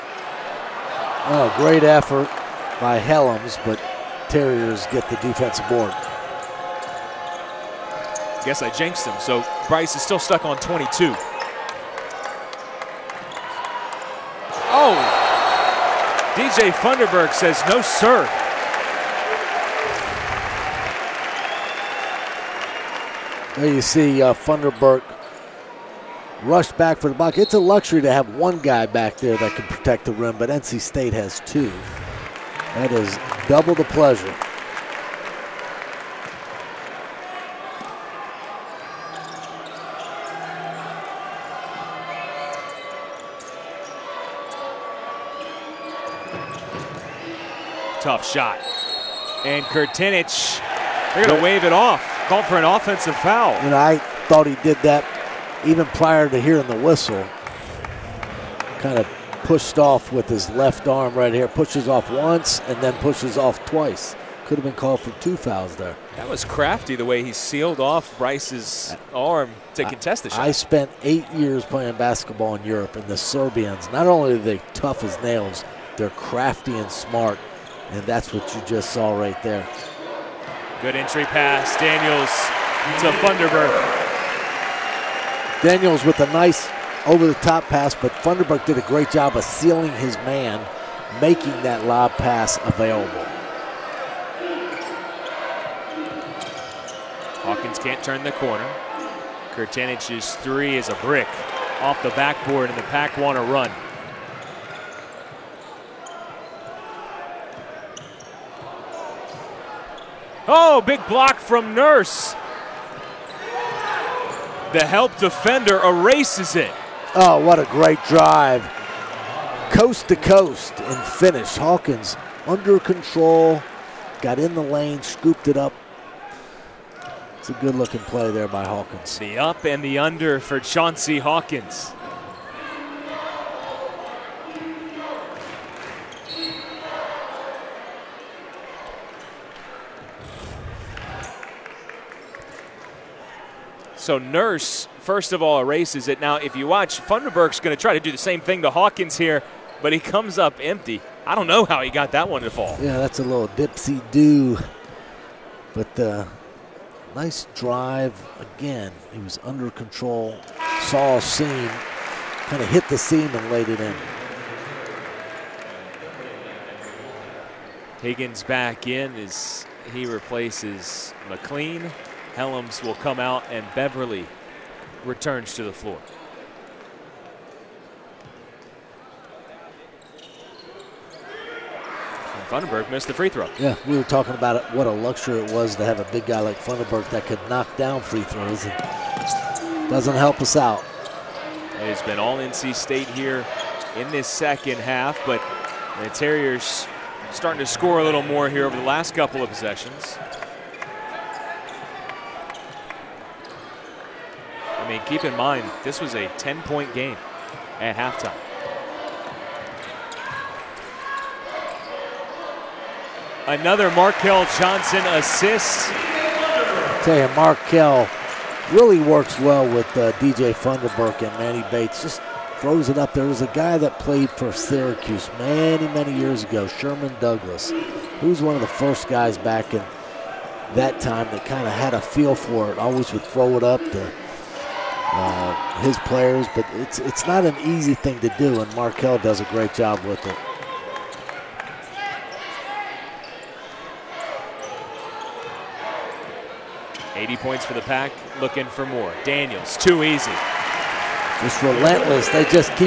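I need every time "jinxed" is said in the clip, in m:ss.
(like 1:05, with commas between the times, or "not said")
0:08.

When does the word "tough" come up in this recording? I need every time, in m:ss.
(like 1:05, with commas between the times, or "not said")
0:48, 1:14.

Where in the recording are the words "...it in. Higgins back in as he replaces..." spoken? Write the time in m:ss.
2:43.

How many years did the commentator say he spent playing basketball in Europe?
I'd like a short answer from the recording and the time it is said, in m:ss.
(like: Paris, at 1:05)
8, at 1:11.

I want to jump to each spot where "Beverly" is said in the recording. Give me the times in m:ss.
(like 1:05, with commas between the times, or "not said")
2:53.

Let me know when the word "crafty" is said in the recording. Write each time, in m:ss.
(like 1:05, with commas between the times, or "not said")
1:06, 1:16.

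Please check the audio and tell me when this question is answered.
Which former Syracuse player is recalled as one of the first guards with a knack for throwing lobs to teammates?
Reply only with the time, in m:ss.
3:46.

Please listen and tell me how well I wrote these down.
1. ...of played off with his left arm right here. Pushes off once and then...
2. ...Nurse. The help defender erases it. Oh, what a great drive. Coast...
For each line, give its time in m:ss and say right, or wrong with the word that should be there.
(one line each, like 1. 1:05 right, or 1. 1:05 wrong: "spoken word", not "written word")
1. 0:58 wrong: "pushed", not "played"
2. 1:51 right.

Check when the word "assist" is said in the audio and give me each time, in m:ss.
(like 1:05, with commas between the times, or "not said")
3:35.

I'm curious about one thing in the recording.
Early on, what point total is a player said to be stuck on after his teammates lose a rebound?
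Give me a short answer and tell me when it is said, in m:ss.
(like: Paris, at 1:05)
22, at 0:10.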